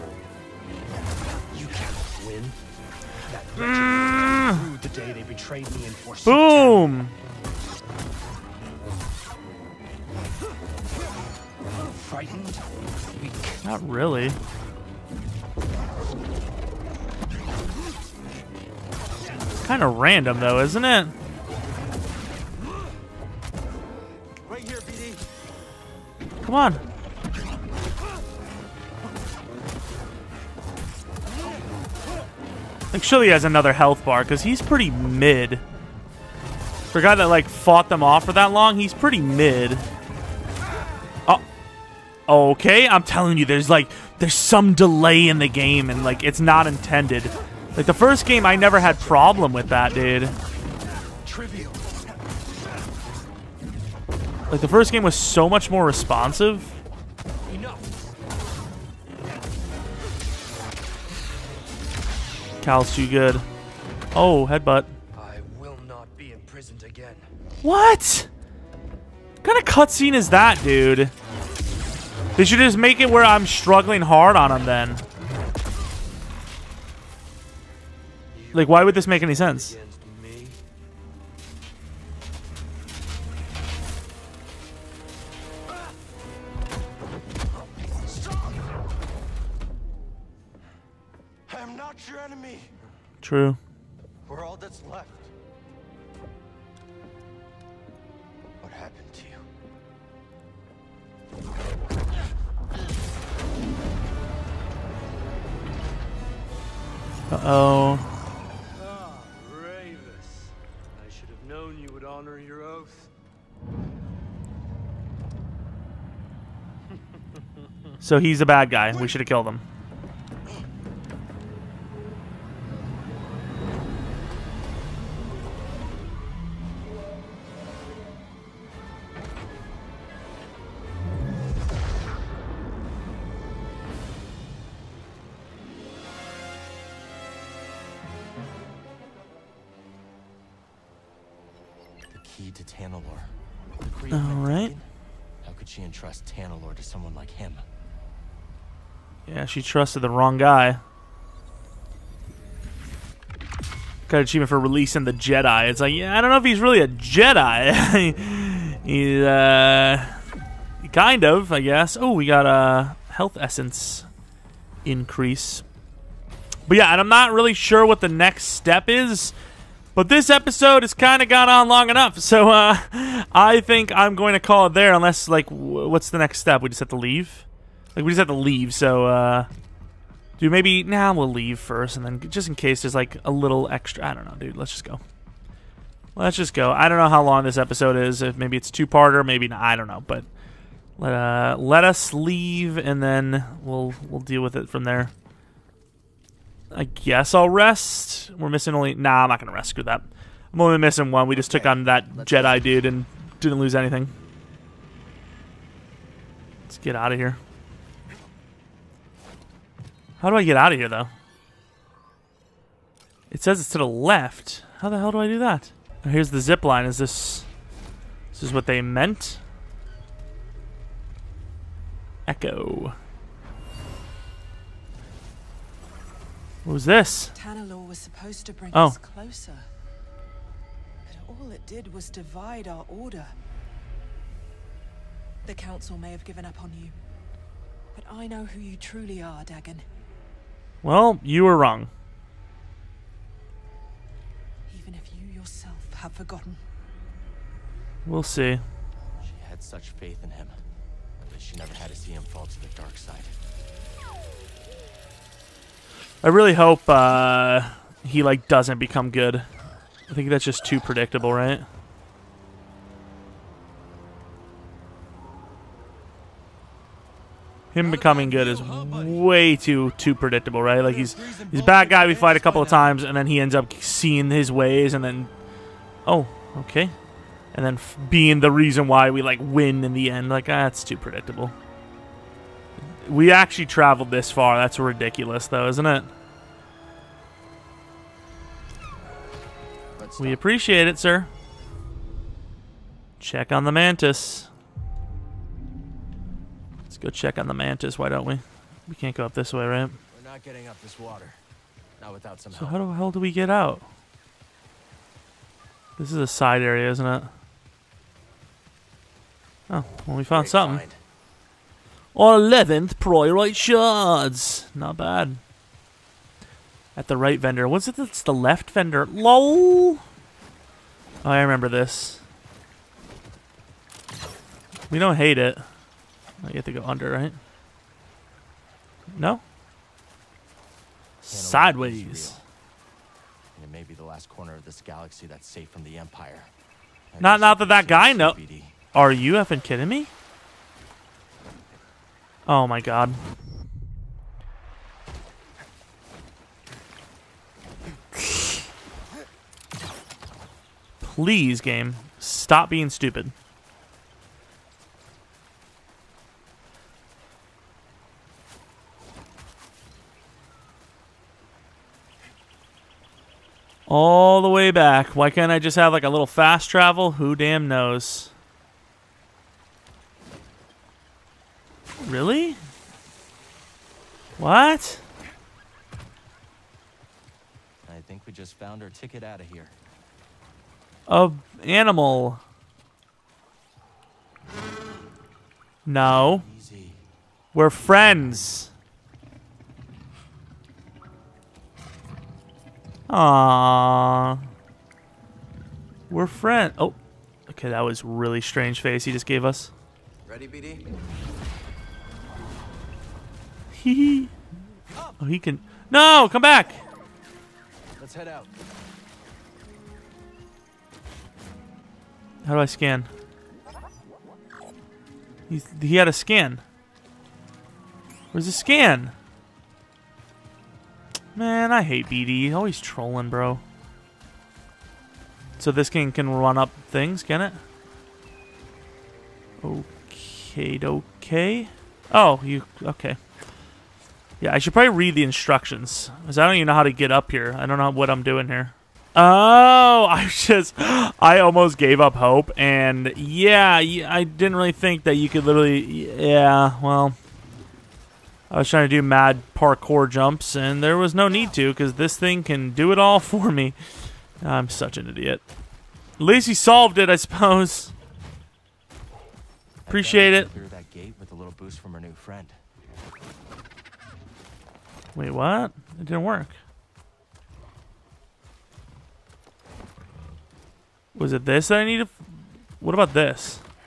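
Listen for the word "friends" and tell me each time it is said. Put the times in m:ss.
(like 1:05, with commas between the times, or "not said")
6:27, 6:36, 7:42.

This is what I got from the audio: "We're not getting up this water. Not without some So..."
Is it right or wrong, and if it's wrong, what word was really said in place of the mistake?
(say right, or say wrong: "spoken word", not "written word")
right.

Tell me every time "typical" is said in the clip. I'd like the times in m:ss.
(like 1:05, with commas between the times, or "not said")
not said.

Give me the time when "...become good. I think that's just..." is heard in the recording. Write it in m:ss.
4:18.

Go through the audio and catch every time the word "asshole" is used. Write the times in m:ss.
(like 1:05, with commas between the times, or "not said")
not said.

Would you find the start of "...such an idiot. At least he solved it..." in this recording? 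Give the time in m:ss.
7:34.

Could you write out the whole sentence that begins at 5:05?
This is a side area, isn't it?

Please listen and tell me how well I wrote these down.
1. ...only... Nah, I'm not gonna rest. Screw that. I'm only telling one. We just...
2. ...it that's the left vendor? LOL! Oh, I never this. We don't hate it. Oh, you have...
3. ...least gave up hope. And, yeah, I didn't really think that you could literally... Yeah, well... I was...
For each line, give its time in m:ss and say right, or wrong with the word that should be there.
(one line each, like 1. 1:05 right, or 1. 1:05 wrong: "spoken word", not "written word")
1. 3:18 wrong: "missing", not "telling"
2. 5:17 wrong: "remember", not "never"
3. 7:21 wrong: "almost", not "least".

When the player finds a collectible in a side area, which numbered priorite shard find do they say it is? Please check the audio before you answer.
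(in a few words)
11th.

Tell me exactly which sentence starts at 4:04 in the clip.
Even if you yourself have forgotten.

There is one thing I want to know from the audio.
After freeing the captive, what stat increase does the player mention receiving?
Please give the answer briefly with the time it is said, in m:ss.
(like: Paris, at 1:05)
Health essence, at 2:43.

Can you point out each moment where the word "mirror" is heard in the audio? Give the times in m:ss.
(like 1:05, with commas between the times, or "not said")
not said.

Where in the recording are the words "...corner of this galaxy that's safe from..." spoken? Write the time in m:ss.
5:34.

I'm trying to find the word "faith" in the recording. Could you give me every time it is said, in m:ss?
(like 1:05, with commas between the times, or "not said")
4:09.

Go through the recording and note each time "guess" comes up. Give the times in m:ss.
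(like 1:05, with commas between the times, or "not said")
2:41, 3:16.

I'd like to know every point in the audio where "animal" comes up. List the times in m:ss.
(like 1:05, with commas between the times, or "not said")
6:21.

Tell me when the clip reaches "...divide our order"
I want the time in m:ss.
3:52.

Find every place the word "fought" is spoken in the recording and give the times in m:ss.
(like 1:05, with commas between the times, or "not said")
0:37.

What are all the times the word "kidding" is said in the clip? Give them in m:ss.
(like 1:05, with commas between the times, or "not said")
5:39.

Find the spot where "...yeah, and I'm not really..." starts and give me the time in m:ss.
2:46.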